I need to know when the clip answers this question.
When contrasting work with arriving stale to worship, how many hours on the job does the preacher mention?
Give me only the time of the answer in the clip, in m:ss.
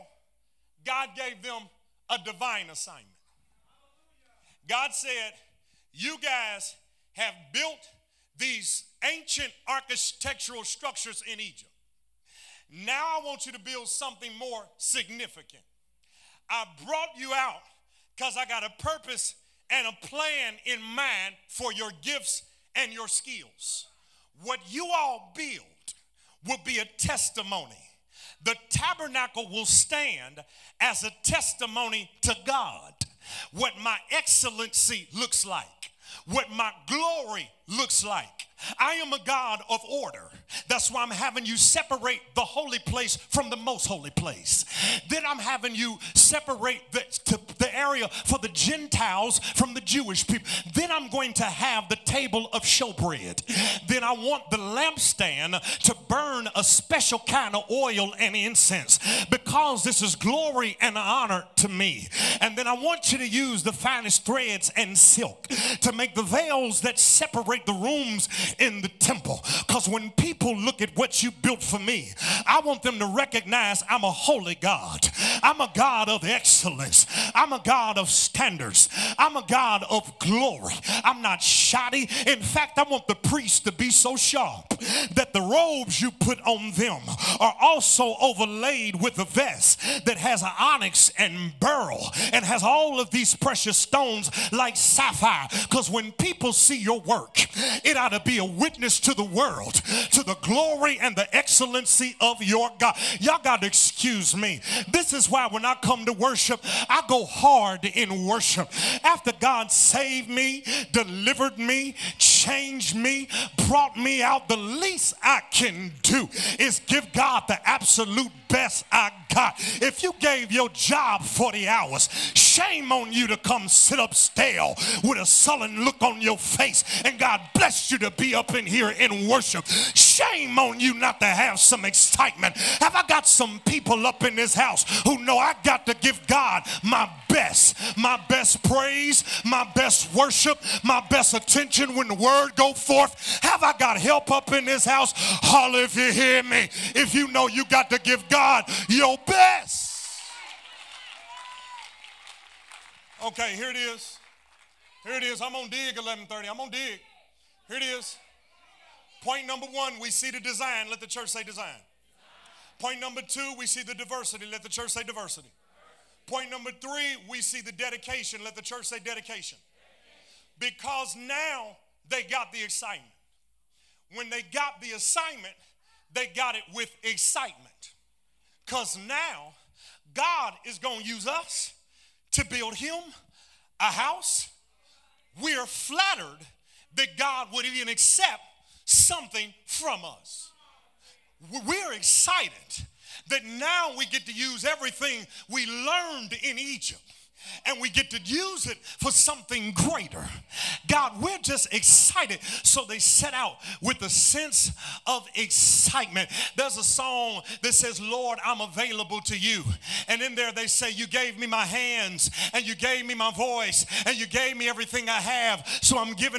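2:01.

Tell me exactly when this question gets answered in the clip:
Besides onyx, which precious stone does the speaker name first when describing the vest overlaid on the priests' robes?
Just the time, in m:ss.
1:31.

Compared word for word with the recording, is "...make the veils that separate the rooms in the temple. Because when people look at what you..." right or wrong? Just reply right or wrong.
right.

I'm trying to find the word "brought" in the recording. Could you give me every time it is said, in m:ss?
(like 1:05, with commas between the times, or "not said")
0:16, 1:53.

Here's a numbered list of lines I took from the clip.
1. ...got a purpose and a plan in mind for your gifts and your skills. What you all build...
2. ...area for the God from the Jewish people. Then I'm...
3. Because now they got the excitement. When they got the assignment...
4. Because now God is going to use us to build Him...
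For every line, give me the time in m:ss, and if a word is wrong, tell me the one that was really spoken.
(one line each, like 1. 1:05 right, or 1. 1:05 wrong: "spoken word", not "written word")
1. 0:18 right
2. 0:47 wrong: "Gentiles", not "God"
3. 2:50 right
4. 2:58 right.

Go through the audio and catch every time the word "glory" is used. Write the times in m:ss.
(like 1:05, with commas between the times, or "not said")
0:36, 1:00, 1:20, 1:40.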